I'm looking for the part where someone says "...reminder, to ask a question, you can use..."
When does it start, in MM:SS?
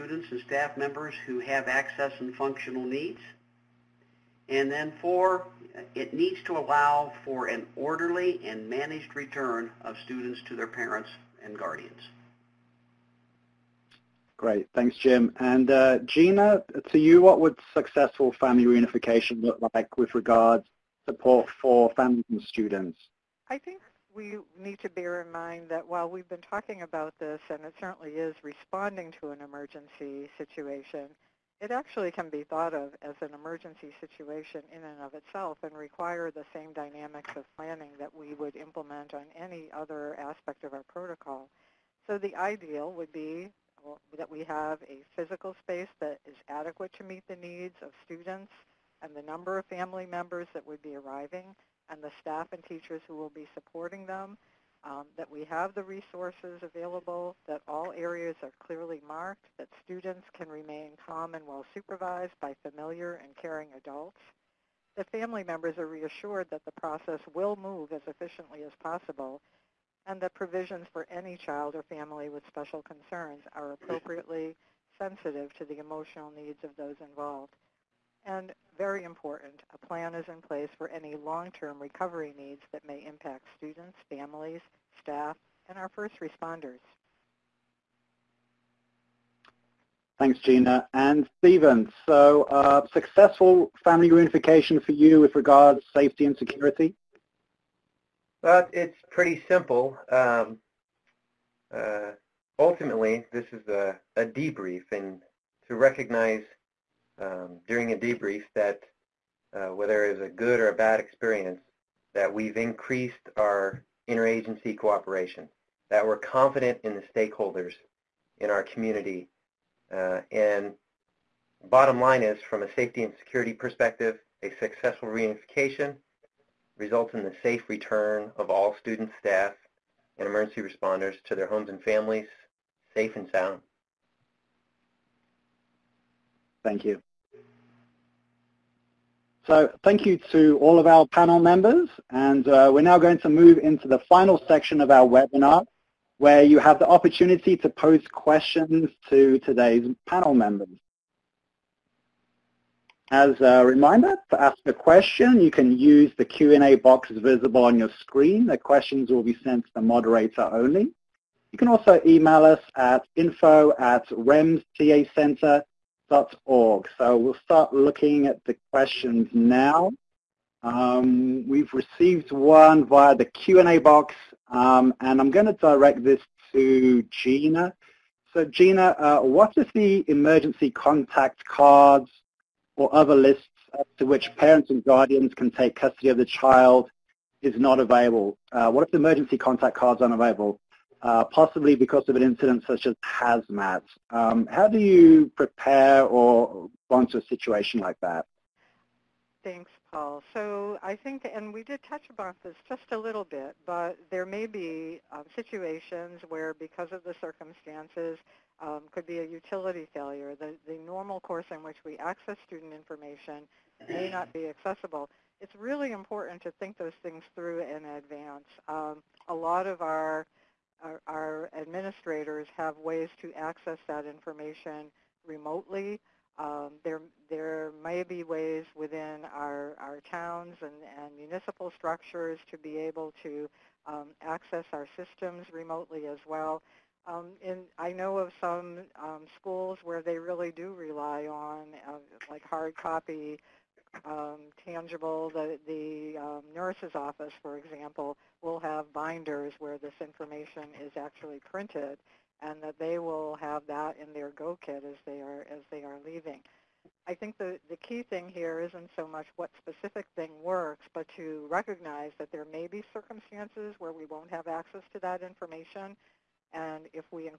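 02:33.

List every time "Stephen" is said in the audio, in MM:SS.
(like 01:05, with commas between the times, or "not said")
01:31.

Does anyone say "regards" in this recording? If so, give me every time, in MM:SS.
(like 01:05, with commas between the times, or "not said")
00:20, 01:35.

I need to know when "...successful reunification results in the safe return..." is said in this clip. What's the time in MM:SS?
02:04.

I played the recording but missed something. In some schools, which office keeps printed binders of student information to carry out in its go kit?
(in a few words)
nurse's office.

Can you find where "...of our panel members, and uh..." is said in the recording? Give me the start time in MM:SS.
02:20.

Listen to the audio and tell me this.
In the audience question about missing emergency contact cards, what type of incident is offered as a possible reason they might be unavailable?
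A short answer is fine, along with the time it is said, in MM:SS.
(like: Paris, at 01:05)
hazmat, at 03:13.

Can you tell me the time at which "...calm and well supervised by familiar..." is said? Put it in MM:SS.
01:01.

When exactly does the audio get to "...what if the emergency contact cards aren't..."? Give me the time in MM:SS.
03:08.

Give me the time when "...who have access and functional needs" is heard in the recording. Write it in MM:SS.
00:01.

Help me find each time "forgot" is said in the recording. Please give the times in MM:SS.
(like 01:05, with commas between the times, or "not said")
not said.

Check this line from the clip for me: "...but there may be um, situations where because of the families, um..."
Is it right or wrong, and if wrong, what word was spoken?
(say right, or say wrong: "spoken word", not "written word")
wrong: "circumstances", not "families".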